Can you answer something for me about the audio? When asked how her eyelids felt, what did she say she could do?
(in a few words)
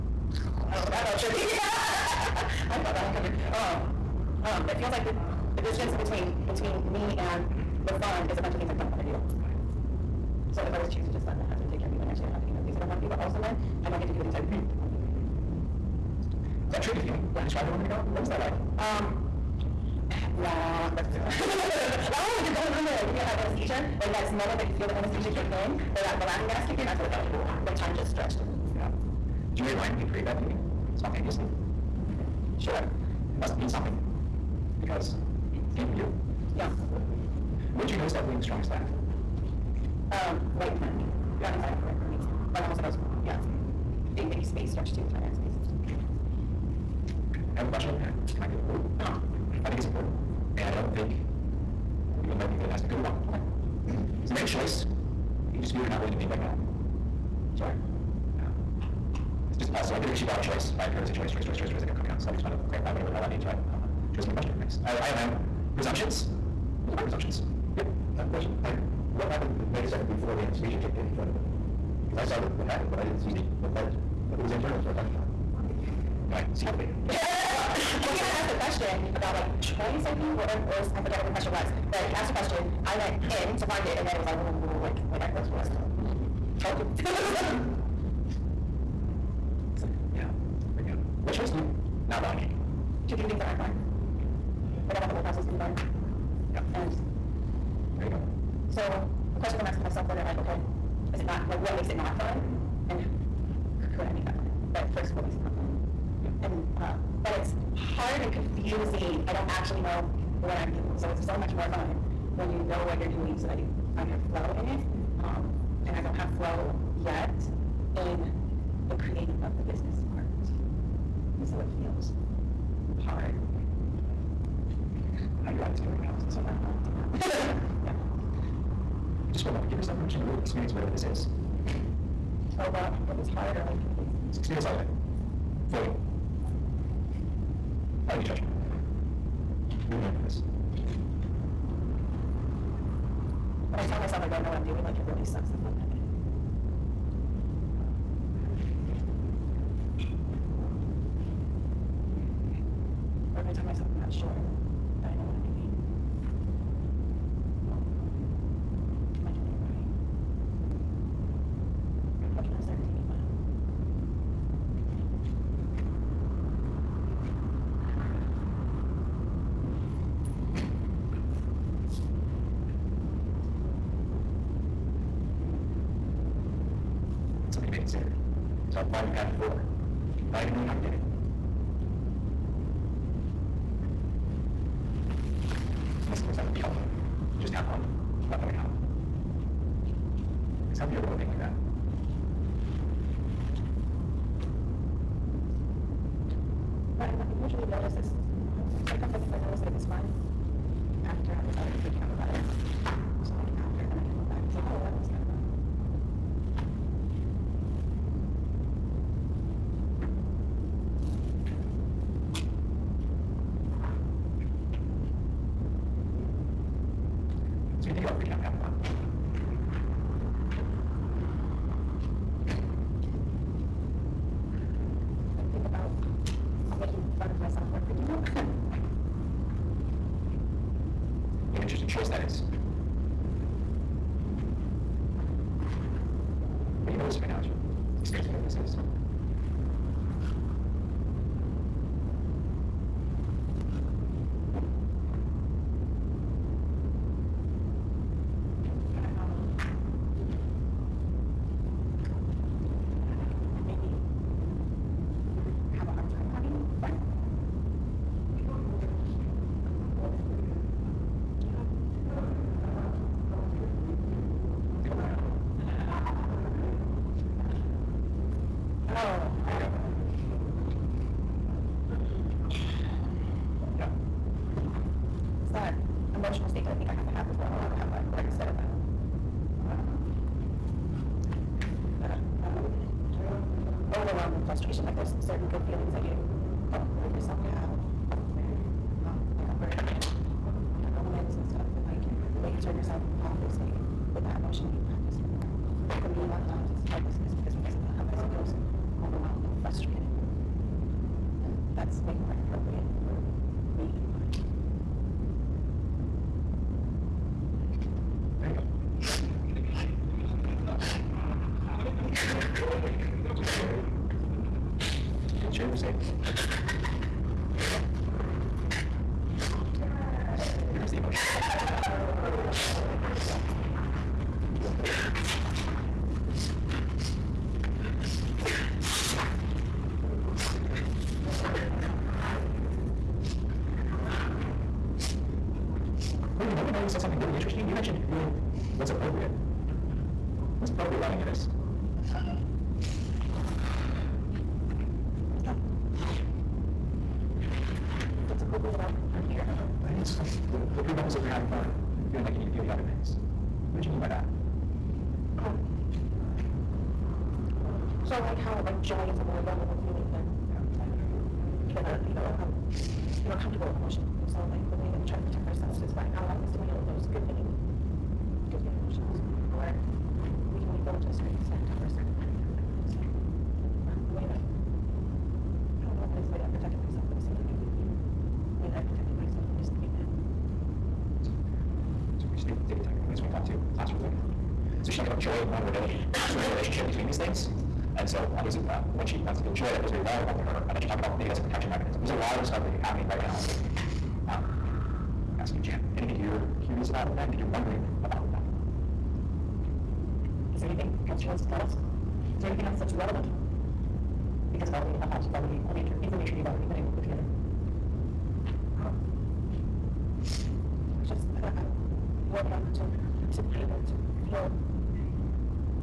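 Take a nap.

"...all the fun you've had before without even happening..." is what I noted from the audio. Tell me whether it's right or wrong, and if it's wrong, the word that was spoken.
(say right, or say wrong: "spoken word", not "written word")
wrong: "knowing", not "happening".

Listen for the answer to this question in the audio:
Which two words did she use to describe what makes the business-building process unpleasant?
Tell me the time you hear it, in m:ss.
1:47.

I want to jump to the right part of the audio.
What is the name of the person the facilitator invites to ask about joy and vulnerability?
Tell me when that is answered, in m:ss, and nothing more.
6:35.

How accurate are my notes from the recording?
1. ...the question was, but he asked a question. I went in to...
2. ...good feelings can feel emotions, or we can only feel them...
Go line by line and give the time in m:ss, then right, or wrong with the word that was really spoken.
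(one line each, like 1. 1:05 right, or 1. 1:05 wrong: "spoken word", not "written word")
1. 1:21 right
2. 6:07 right.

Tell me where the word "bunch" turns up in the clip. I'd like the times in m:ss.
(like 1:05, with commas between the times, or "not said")
0:08, 1:04.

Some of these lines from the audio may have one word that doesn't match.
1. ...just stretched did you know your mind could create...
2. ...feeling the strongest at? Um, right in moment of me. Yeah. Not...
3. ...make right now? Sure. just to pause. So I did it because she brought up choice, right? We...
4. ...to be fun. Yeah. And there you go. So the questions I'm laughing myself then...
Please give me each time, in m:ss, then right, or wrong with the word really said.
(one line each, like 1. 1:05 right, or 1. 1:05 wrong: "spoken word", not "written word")
1. 0:27 right
2. 0:38 wrong: "front", not "moment"
3. 0:56 right
4. 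1:35 wrong: "asking", not "laughing".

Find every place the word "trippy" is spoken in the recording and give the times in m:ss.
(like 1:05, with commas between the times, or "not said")
0:01, 0:16.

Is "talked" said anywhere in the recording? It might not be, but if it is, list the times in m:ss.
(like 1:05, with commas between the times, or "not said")
6:24, 6:30.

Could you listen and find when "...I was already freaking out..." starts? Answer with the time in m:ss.
3:21.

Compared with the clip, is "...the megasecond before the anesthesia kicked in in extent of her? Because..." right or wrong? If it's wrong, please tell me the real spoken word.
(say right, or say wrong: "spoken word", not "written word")
wrong: "front", not "extent".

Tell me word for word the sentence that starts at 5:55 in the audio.
Um, so like how like joy is a more vulnerable feeling than yeah.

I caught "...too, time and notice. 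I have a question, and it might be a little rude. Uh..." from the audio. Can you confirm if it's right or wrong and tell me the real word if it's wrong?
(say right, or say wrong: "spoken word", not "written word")
wrong: "space", not "notice".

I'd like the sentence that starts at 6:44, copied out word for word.
Because of all the ahas you've already, all the information you've already been able to put together.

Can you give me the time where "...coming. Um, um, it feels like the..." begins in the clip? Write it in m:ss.
0:03.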